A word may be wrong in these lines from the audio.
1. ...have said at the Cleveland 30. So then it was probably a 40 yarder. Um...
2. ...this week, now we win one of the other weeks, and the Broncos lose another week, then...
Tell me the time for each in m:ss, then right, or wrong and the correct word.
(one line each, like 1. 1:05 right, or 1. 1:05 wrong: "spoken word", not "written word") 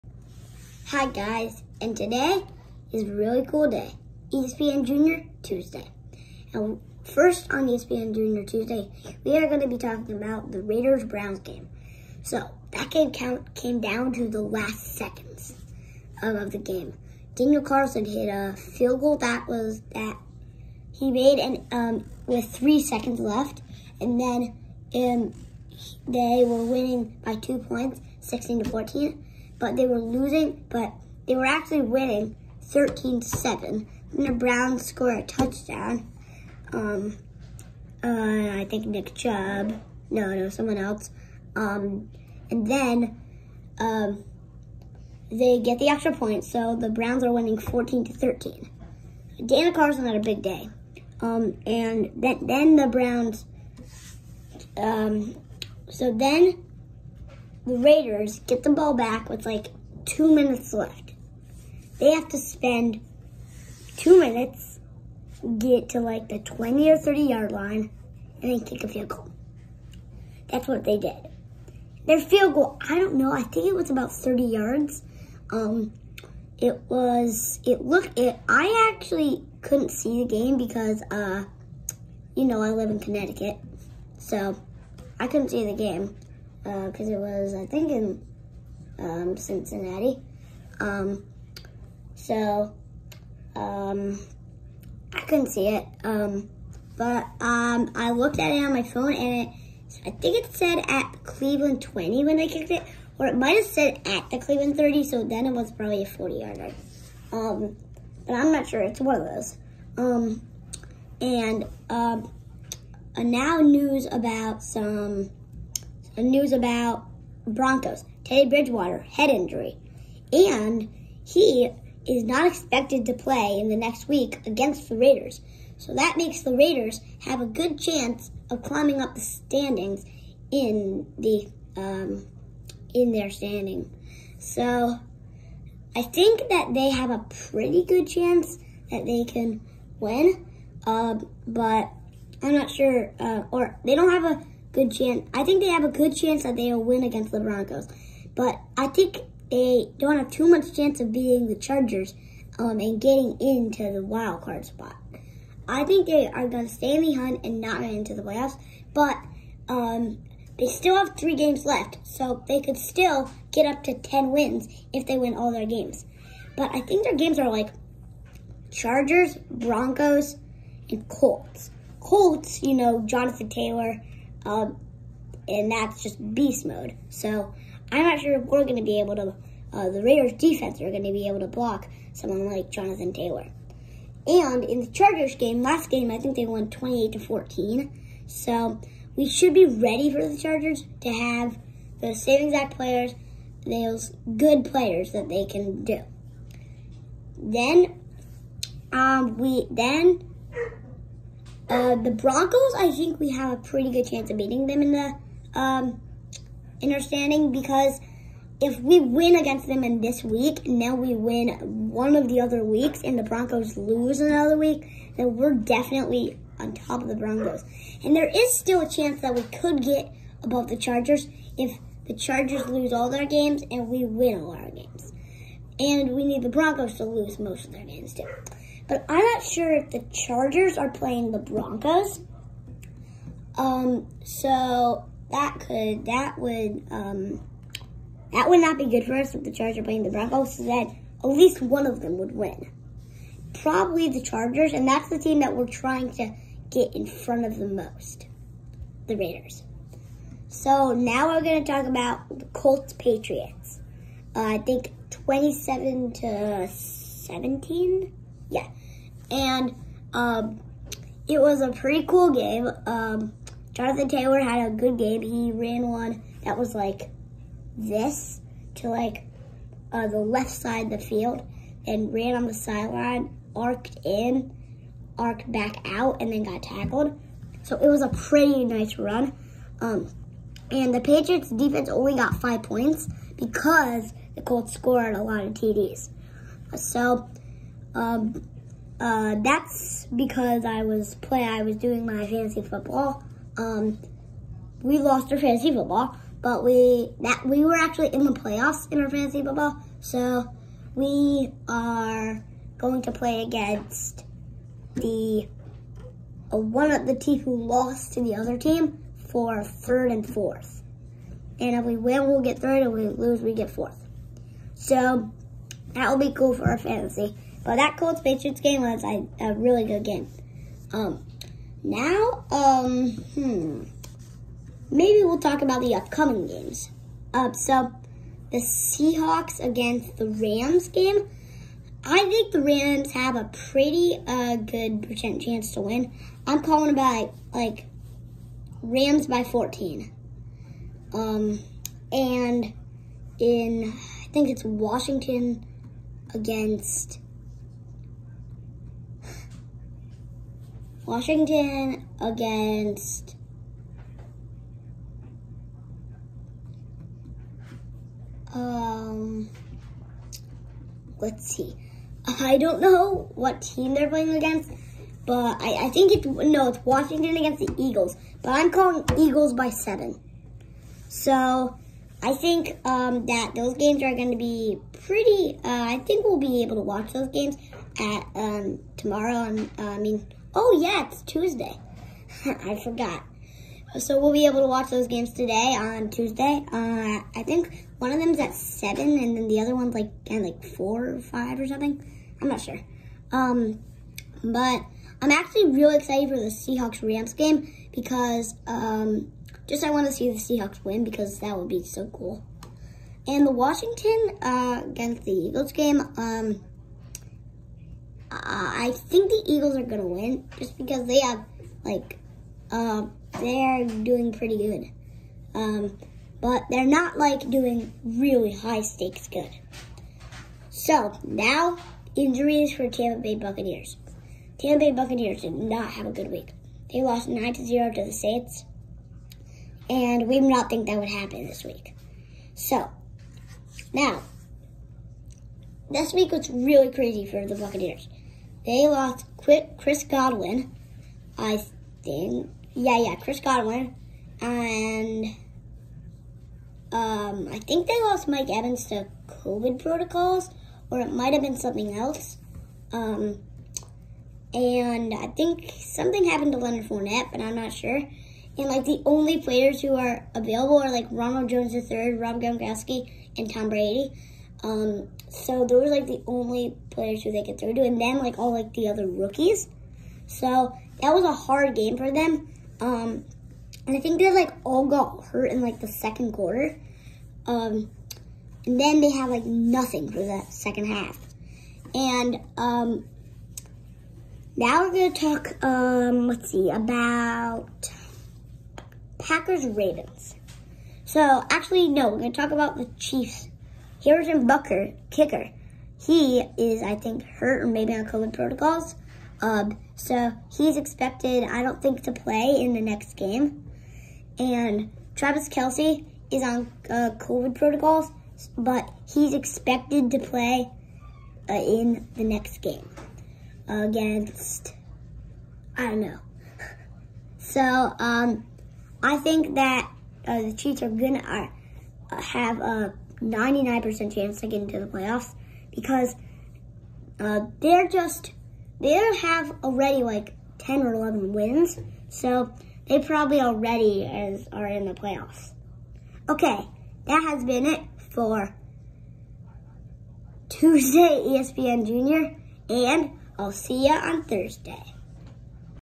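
1. 1:43 right
2. 3:30 right.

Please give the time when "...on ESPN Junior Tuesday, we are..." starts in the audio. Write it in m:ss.
0:07.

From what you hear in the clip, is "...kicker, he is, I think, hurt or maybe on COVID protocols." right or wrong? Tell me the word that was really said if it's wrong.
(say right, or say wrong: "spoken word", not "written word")
right.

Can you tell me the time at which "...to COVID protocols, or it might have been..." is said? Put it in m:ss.
7:28.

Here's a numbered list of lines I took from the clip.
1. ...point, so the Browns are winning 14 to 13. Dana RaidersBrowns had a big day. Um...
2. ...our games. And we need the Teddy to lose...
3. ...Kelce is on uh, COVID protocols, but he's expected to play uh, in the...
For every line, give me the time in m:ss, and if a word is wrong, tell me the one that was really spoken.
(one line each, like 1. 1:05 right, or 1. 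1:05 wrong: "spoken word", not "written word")
1. 0:46 wrong: "Carson", not "RaidersBrowns"
2. 3:44 wrong: "Broncos", not "Teddy"
3. 8:25 right.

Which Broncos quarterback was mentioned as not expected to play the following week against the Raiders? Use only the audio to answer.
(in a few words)
Teddy Bridgewater.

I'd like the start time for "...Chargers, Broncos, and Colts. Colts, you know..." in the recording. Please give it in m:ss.
2:48.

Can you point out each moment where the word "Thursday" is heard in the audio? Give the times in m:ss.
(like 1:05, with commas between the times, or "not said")
9:04.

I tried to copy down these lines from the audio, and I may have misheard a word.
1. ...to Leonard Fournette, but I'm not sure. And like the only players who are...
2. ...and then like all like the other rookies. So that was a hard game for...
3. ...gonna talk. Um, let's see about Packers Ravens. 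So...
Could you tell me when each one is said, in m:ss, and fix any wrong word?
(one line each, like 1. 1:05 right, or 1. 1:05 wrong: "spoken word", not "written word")
1. 7:36 right
2. 7:47 right
3. 8:05 right.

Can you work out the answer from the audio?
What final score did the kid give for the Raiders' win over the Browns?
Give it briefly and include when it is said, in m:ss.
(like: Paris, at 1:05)
16 to 14, at 0:28.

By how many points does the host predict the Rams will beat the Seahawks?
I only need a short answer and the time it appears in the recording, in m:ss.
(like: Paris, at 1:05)
14, at 5:38.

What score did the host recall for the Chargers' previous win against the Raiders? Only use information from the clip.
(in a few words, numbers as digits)
28 to 14.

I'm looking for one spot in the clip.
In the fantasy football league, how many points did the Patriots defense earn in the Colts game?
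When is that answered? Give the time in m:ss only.
4:42.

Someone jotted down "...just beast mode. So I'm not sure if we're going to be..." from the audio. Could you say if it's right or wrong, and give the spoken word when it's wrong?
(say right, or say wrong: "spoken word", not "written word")
right.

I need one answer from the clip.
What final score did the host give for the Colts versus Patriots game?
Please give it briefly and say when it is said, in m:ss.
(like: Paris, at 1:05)
27 to 17, at 4:15.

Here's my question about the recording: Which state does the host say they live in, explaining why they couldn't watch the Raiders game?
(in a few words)
Connecticut.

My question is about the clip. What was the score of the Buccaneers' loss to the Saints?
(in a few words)
9 to 0.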